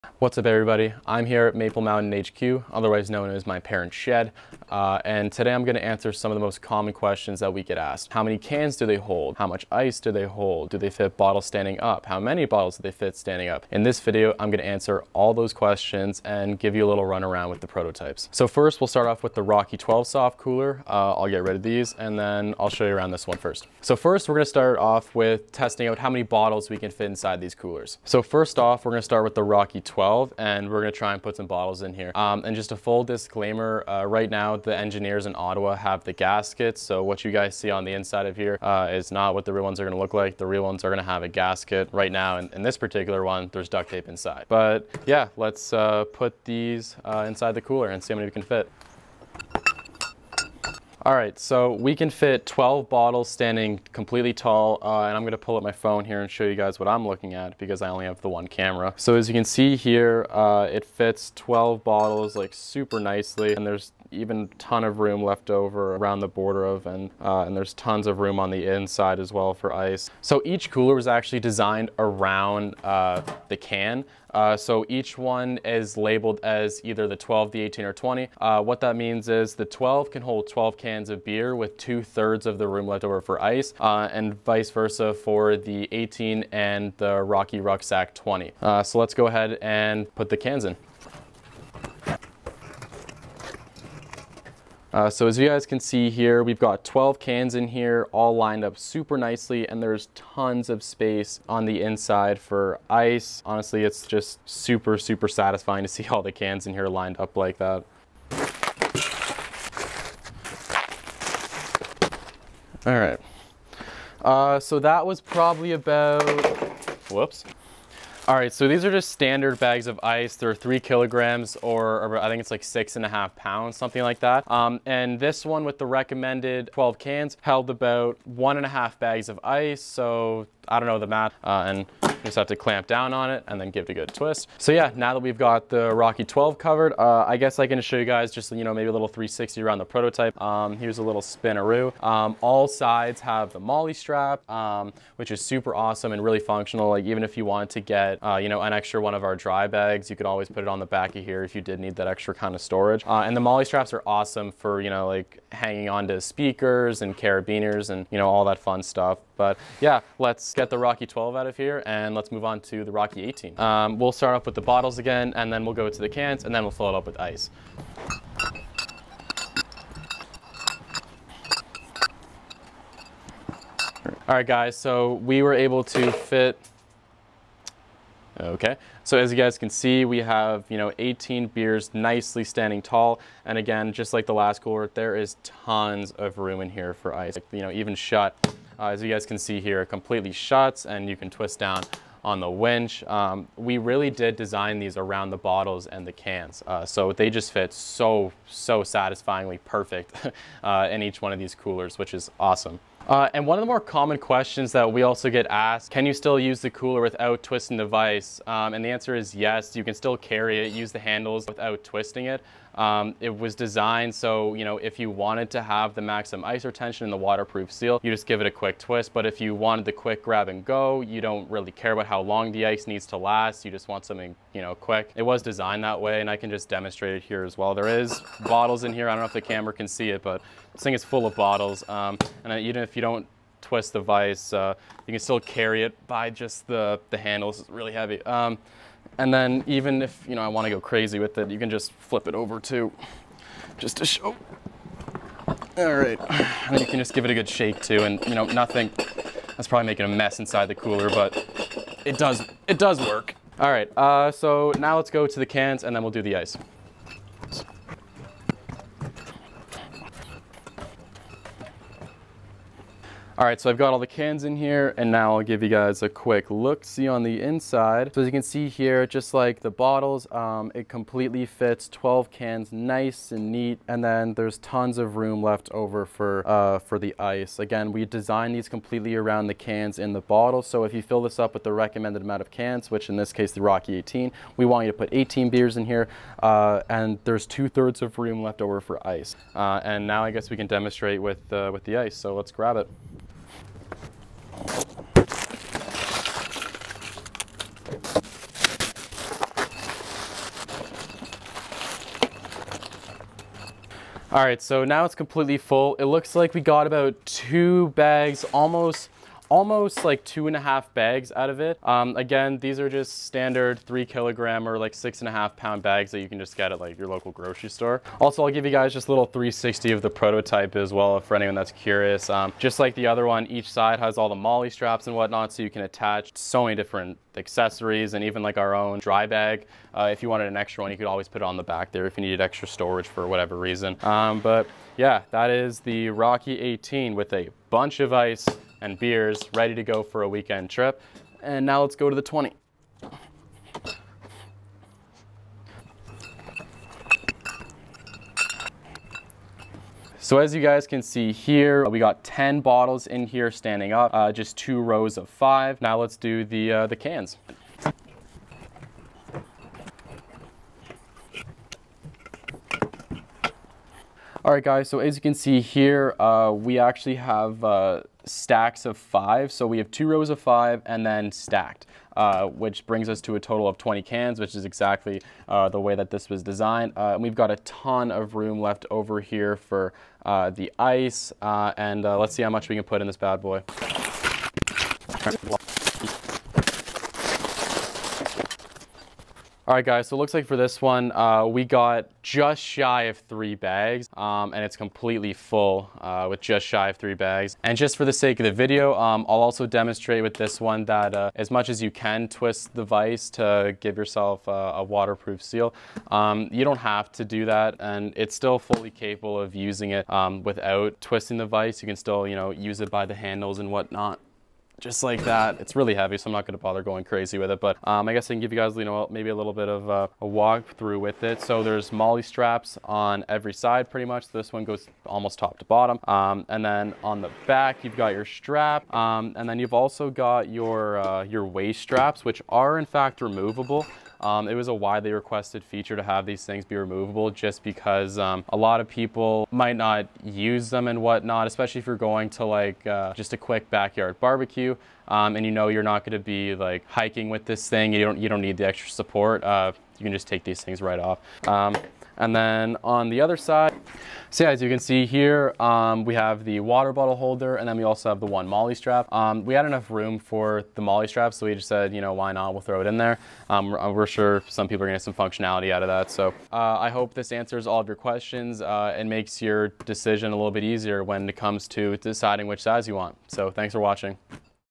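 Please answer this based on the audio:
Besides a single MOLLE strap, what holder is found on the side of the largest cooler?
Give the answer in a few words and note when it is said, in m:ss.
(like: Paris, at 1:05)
water bottle holder, at 7:36.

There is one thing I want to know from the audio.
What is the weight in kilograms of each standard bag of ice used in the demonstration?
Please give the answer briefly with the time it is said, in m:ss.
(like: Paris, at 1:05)
3 kilograms, at 2:00.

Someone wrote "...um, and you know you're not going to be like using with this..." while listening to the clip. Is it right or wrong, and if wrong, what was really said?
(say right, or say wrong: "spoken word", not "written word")
wrong: "hiking", not "using".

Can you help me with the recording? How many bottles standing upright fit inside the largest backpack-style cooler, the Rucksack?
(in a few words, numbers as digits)
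10.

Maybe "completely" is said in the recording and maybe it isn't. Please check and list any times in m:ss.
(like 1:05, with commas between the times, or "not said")
0:53, 3:09, 4:30, 4:38, 5:05, 6:34.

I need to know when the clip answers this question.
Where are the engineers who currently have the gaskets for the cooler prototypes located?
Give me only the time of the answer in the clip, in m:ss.
0:35.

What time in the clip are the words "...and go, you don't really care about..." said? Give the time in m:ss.
3:40.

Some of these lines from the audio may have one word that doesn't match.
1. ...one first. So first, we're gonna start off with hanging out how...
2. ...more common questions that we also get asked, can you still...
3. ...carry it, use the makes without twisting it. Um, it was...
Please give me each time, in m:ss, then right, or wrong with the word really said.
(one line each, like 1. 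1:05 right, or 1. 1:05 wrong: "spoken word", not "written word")
1. 0:23 wrong: "testing", not "hanging"
2. 3:23 right
3. 3:30 wrong: "handles", not "makes".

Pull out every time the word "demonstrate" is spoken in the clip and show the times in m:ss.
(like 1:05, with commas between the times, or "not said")
3:46, 4:50, 6:39.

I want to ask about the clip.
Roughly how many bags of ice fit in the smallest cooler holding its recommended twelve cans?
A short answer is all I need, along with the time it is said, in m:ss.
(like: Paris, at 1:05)
1.5, at 2:08.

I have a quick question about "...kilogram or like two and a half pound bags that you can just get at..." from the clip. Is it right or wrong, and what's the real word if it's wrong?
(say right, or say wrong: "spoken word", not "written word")
wrong: "six", not "two".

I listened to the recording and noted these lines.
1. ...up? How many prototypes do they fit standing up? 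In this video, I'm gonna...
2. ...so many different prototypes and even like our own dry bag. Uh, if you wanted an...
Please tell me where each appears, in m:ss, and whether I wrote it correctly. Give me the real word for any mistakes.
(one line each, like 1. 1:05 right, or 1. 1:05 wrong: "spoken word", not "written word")
1. 0:11 wrong: "bottles", not "prototypes"
2. 5:26 wrong: "accessories", not "prototypes".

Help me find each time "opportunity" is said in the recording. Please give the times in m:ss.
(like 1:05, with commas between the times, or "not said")
not said.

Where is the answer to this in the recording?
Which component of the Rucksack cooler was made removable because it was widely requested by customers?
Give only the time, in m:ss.
7:11.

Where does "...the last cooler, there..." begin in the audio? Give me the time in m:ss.
3:04.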